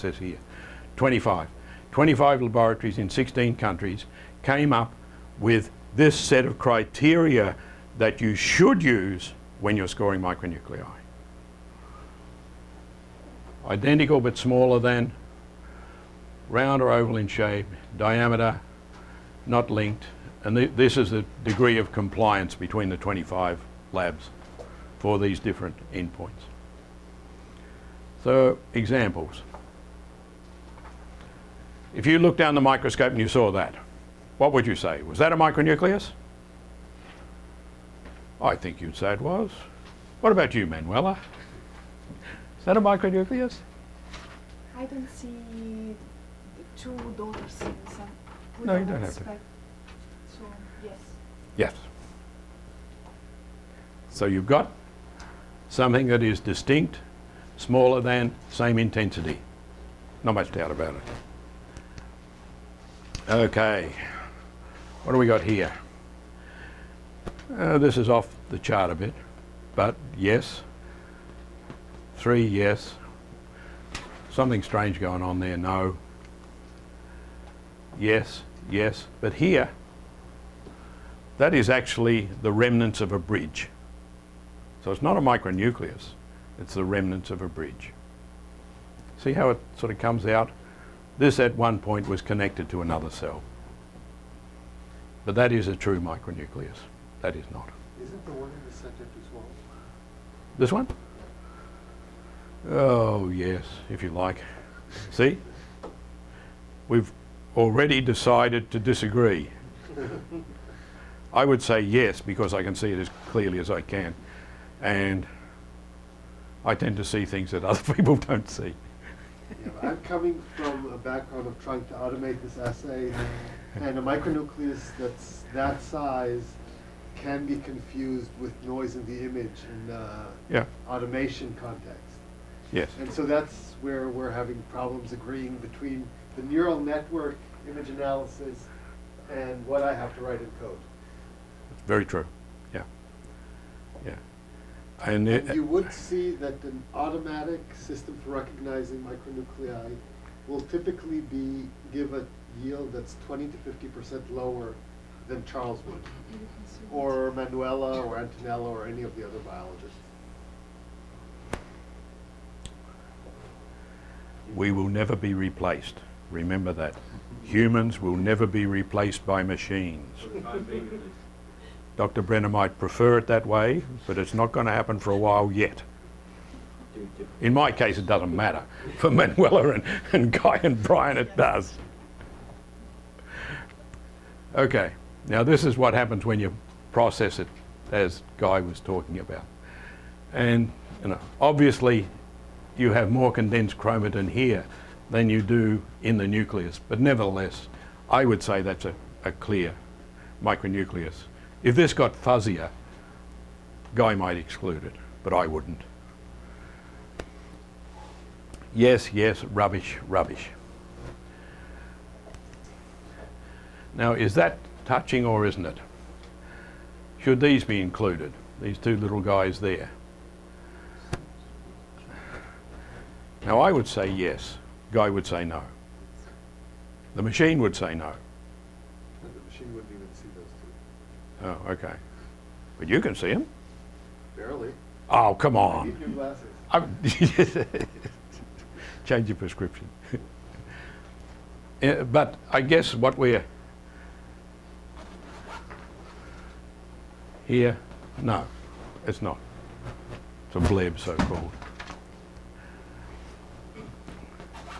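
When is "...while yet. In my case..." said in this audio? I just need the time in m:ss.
2:55.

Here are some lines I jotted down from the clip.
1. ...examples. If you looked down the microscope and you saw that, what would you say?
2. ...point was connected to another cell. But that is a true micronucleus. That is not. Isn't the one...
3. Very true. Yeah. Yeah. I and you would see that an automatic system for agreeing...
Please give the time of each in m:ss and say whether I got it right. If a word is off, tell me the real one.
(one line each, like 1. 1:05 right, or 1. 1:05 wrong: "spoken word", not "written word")
1. 0:28 right
2. 1:31 right
3. 2:21 wrong: "recognizing", not "agreeing".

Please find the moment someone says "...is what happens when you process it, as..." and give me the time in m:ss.
3:05.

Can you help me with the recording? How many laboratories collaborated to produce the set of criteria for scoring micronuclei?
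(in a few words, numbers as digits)
25.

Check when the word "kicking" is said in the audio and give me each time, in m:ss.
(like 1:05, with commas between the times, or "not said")
not said.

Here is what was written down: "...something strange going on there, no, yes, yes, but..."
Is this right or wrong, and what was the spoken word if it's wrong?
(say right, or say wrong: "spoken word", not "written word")
right.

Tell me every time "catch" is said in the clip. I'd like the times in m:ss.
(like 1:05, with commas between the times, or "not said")
not said.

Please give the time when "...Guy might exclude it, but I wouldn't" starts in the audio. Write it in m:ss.
3:23.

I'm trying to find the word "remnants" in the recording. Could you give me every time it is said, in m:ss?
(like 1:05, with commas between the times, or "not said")
1:22, 1:26.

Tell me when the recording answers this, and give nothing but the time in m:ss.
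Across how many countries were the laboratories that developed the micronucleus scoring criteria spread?
0:03.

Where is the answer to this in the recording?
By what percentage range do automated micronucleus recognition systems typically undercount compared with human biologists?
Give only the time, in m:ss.
2:33.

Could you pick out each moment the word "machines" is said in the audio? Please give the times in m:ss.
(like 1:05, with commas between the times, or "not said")
2:49, 3:47.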